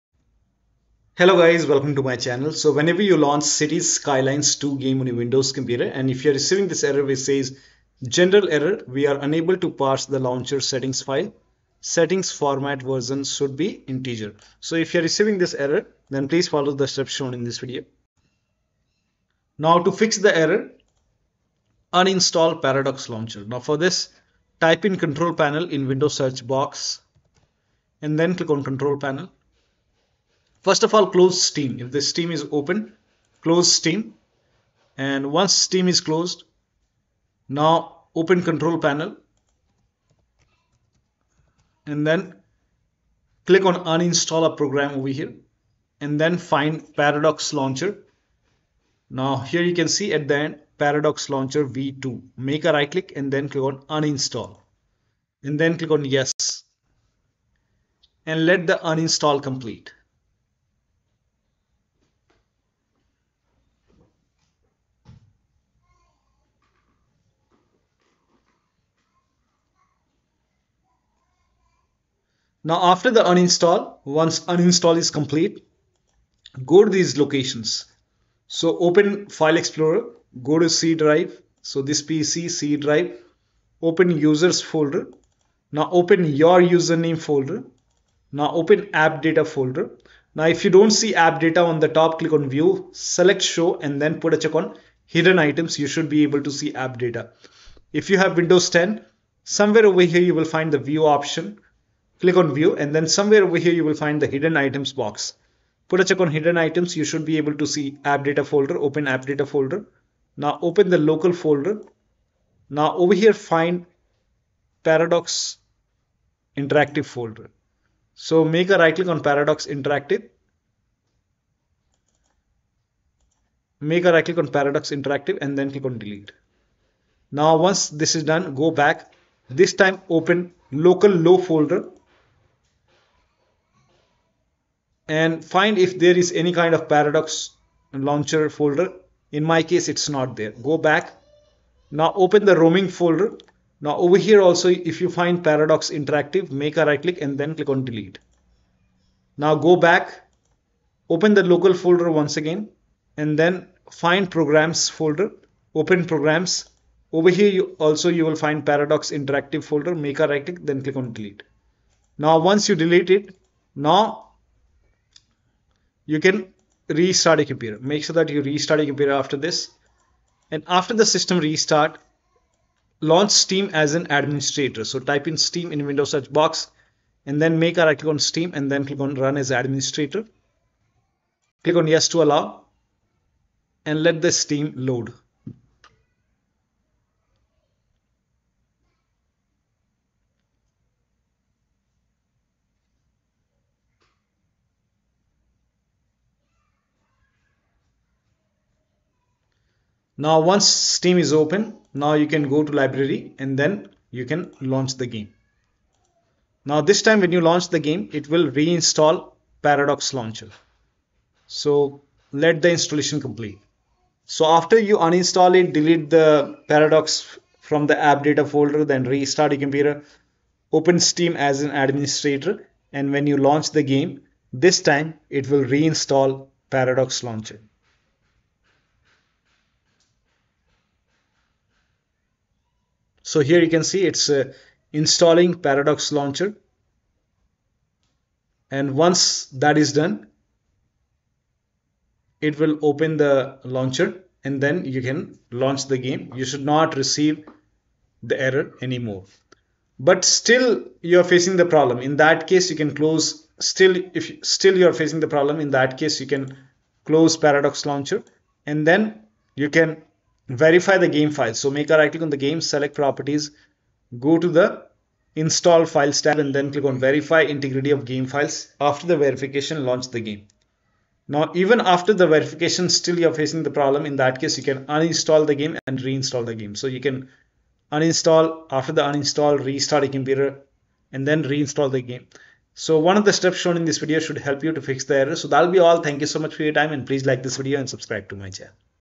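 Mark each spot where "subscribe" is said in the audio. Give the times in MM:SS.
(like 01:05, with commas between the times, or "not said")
04:47.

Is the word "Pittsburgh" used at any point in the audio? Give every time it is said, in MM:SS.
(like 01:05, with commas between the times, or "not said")
not said.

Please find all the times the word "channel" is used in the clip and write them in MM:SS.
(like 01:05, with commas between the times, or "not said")
00:02, 04:48.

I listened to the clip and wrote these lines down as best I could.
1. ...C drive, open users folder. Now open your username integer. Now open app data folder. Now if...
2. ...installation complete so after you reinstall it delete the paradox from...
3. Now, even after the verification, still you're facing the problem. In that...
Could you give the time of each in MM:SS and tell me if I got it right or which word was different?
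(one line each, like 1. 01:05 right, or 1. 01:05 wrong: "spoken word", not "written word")
1. 01:22 wrong: "folder", not "integer"
2. 03:32 wrong: "uninstall", not "reinstall"
3. 04:31 right.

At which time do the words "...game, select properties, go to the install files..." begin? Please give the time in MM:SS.
04:22.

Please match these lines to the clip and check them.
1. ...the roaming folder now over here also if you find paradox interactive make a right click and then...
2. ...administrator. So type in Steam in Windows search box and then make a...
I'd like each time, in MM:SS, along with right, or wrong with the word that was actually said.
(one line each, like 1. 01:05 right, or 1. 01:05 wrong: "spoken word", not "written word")
1. 02:22 right
2. 02:54 right.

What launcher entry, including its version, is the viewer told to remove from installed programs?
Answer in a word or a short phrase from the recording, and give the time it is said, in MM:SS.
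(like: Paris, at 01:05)
Paradox Launcher V2, at 00:50.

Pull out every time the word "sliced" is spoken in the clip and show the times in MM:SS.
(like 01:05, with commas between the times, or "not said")
not said.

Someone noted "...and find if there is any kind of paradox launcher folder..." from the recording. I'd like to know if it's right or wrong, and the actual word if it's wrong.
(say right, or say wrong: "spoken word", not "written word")
right.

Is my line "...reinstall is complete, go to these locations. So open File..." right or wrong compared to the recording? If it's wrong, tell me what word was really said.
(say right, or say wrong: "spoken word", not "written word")
wrong: "uninstall", not "reinstall".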